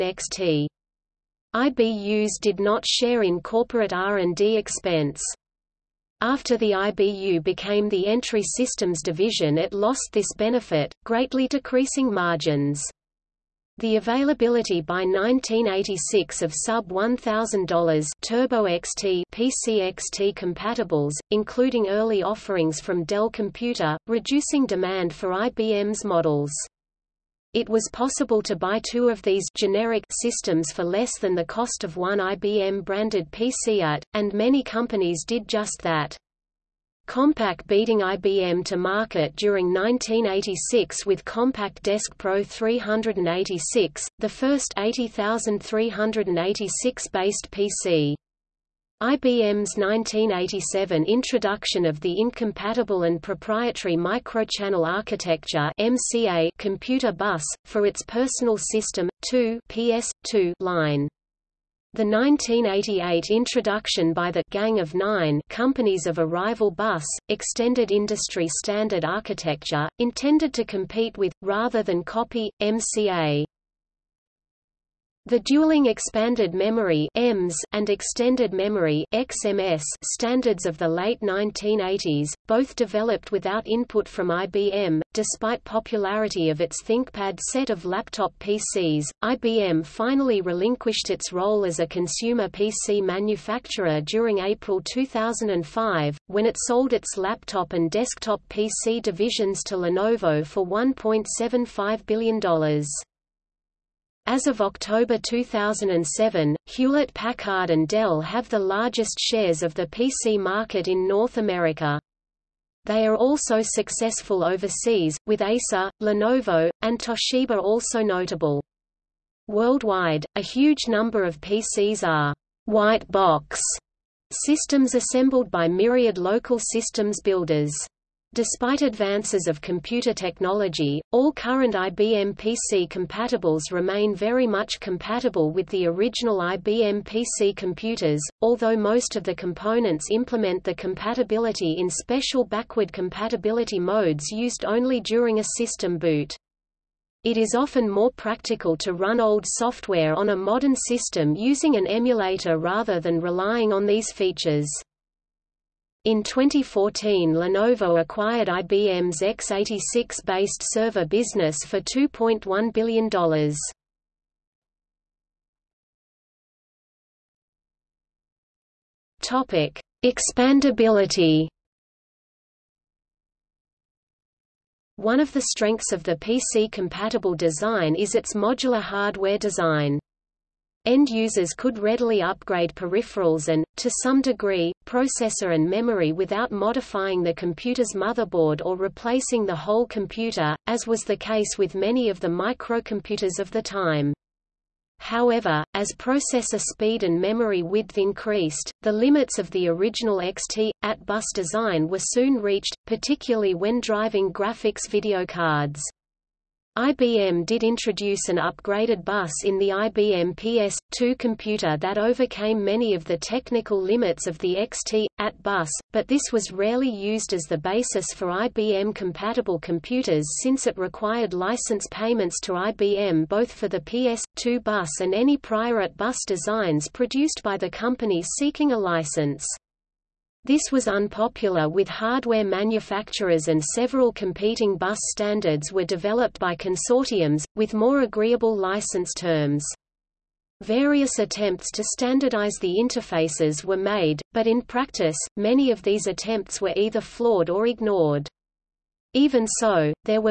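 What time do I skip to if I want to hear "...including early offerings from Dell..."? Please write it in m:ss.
0:21.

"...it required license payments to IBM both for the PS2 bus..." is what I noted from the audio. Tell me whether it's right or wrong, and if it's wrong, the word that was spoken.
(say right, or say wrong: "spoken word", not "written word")
right.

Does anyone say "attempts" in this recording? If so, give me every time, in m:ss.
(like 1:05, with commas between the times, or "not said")
4:01, 4:06.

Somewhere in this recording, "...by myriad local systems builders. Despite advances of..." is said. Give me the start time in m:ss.
2:05.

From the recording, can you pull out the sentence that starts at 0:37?
Compaq beating IBM to market during 1986 with Compaq Deskpro 386, the first 80386 based PC.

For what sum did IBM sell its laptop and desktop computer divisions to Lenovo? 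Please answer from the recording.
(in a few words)
$1.75 billion.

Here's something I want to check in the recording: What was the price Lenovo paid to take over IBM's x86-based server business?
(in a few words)
$2.1 billion.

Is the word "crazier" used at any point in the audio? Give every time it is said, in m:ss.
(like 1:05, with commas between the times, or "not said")
not said.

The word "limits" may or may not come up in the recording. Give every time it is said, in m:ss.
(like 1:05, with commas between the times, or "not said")
3:18, 3:33.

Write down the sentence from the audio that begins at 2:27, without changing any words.
It is often more practical to run old software on a modern system using an emulator rather than relying on these features.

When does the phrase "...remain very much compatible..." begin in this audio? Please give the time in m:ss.
2:13.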